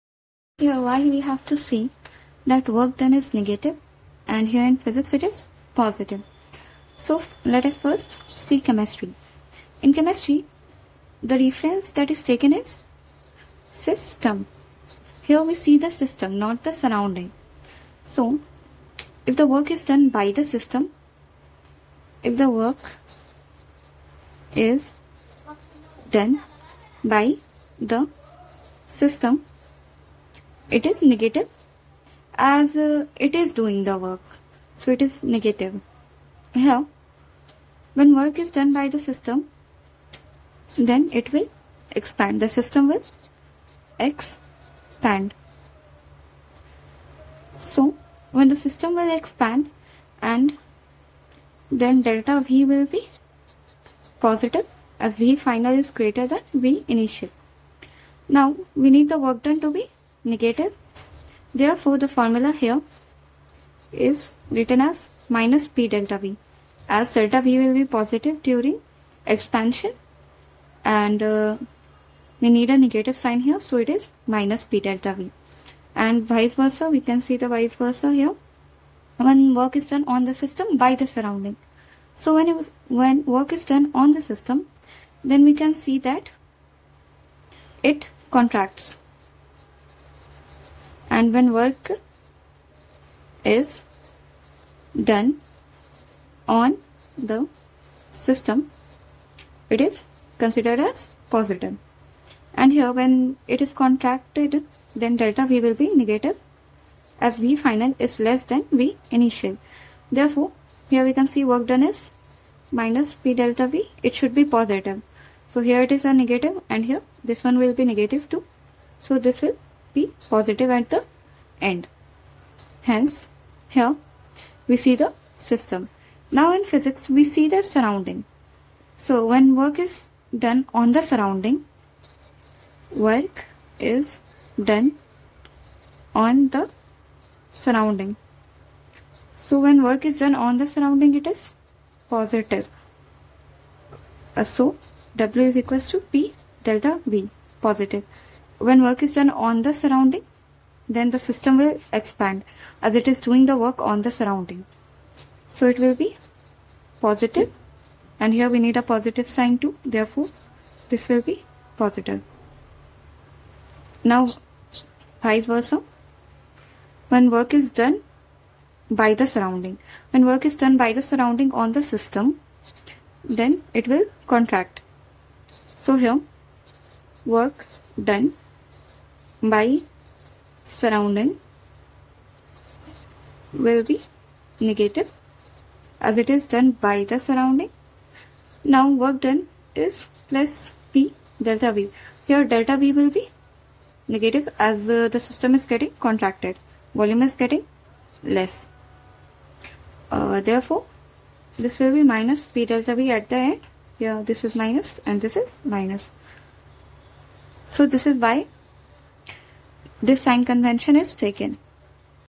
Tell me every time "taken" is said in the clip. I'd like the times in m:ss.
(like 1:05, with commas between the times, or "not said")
0:12, 3:31.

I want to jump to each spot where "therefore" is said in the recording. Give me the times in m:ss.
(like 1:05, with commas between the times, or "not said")
1:01, 1:50, 2:39, 3:20.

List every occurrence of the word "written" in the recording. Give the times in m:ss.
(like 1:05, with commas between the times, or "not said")
1:04.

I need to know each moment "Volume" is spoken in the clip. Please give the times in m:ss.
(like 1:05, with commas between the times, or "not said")
3:16.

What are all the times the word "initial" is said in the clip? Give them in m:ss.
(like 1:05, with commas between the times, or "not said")
0:56, 1:49.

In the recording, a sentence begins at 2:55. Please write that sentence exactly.
So here, work done by surrounding will be negative as it is done by the surrounding.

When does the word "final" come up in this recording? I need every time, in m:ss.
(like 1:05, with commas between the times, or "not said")
0:55, 1:47.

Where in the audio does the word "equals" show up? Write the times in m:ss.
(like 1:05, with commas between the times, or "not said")
2:25.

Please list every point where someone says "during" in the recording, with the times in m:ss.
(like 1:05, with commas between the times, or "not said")
1:08.